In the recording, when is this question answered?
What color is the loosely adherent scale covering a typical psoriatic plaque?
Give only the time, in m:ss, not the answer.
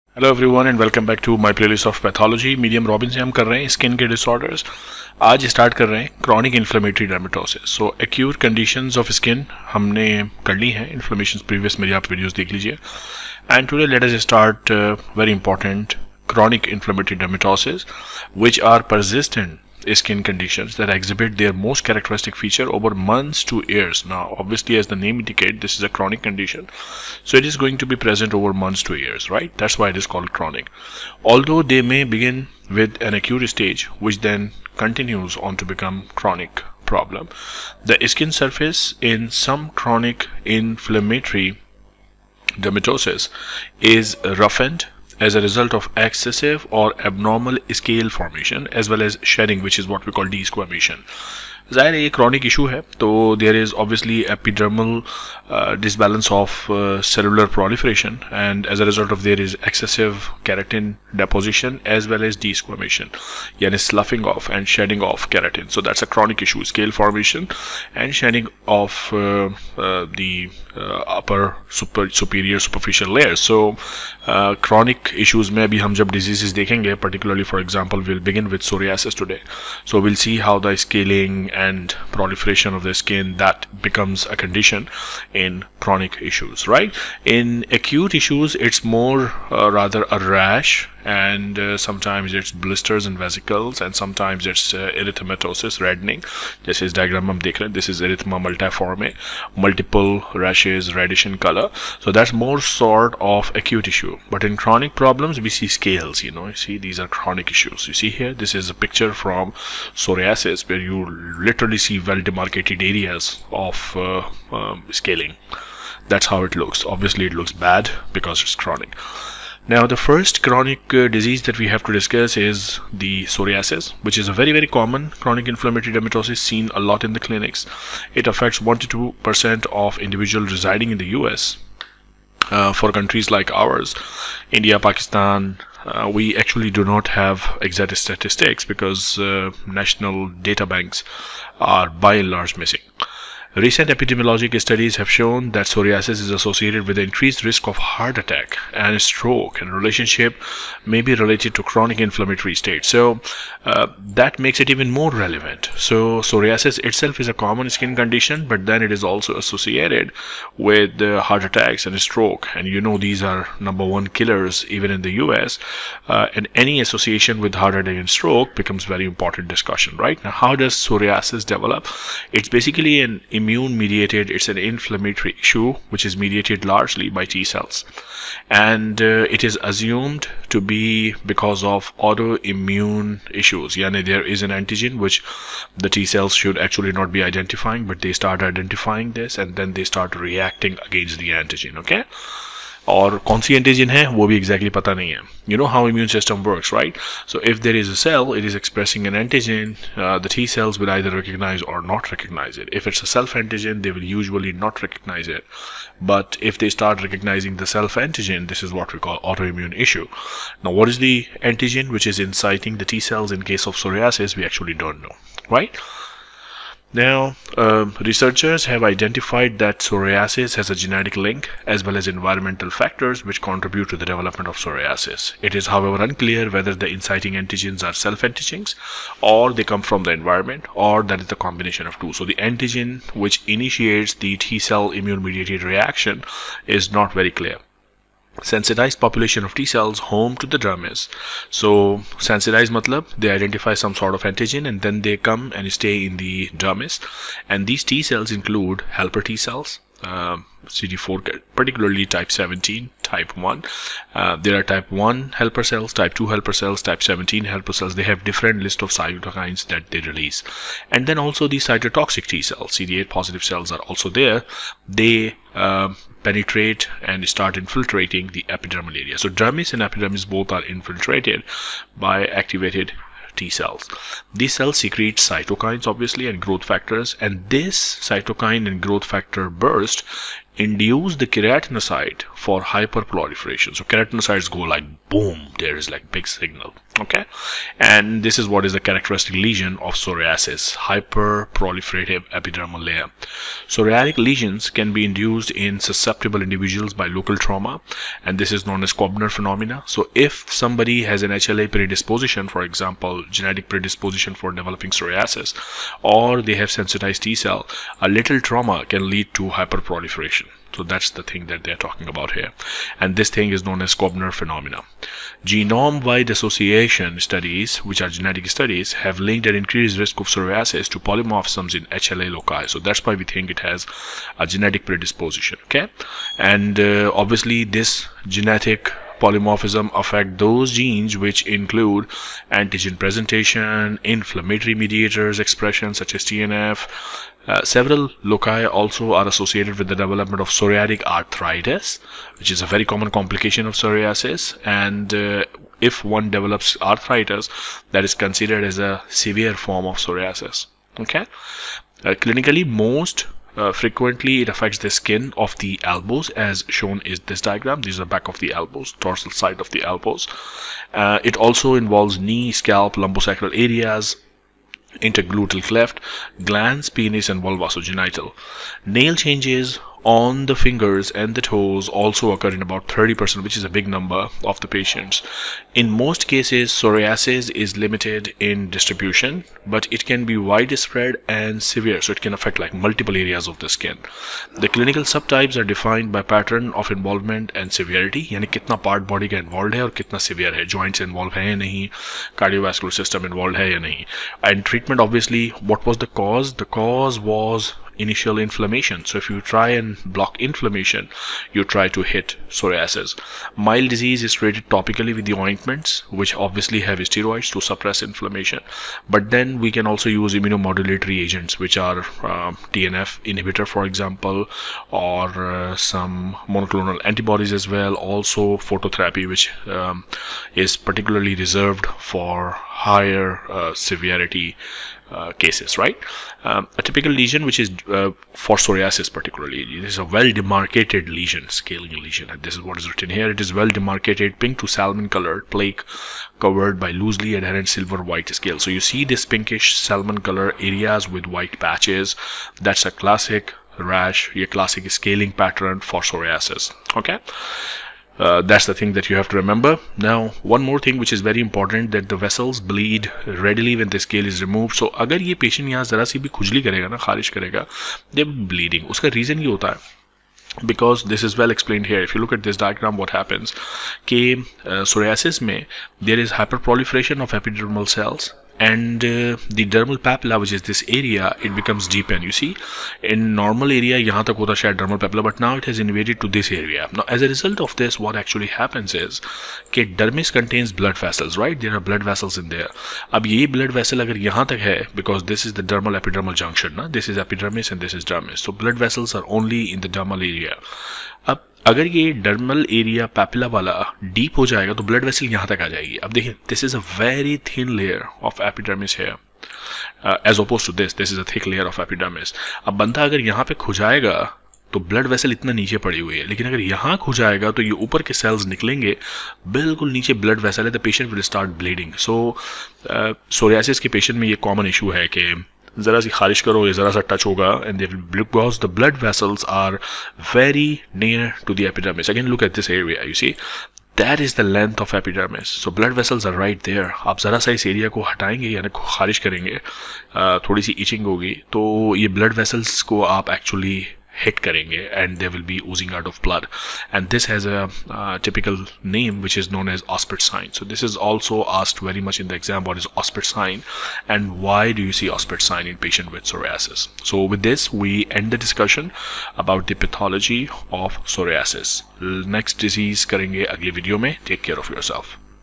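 7:17.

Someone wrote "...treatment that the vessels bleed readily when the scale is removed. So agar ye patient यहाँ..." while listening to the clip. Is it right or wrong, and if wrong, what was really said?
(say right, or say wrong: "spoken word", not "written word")
wrong: "important", not "treatment".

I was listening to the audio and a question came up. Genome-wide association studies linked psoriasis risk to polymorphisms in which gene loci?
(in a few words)
HLA loci.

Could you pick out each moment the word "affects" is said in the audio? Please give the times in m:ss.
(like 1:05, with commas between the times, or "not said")
2:08, 5:30, 5:54, 6:22.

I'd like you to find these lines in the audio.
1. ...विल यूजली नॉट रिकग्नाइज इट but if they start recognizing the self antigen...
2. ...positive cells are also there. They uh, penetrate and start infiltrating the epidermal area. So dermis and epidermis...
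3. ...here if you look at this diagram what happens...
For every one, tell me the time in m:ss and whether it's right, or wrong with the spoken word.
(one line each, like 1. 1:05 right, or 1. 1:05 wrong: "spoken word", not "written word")
1. 3:23 right
2. 4:23 right
3. 7:41 right.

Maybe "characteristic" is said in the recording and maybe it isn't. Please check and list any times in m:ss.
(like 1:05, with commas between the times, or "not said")
0:21, 4:48.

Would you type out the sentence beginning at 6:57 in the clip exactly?
Also phototherapy, which um, is particularly reserved for higher uh, severity uh, cases, right?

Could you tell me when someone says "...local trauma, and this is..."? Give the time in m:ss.
4:57.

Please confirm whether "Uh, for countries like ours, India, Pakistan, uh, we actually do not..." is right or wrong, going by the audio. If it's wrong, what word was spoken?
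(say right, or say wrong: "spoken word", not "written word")
right.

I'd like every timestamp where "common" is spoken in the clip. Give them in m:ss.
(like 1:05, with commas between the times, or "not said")
2:04, 2:37, 5:42.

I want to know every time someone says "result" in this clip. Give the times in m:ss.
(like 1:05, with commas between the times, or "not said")
0:45, 7:57.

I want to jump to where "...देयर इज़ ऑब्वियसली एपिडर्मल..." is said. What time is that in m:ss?
0:53.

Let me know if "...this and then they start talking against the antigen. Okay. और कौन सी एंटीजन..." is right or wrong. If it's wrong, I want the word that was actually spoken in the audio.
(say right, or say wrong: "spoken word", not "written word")
wrong: "reacting", not "talking".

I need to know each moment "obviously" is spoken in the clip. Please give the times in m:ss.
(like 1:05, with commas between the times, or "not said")
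0:24, 1:56, 4:35, 5:27, 6:35, 6:46.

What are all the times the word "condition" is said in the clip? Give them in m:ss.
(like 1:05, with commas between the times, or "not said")
0:20, 0:26, 1:24, 2:37.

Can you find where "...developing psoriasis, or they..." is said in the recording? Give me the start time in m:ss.
5:04.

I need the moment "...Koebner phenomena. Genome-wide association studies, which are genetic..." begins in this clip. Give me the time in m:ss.
5:13.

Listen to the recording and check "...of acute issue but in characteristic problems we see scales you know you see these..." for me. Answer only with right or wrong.
wrong.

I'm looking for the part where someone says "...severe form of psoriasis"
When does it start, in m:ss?
5:49.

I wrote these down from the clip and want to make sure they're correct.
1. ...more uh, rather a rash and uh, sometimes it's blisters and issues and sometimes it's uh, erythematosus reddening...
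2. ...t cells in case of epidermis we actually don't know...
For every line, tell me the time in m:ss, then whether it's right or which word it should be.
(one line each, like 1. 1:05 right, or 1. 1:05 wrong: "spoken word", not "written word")
1. 1:28 wrong: "vesicles", not "issues"
2. 3:32 wrong: "psoriasis", not "epidermis".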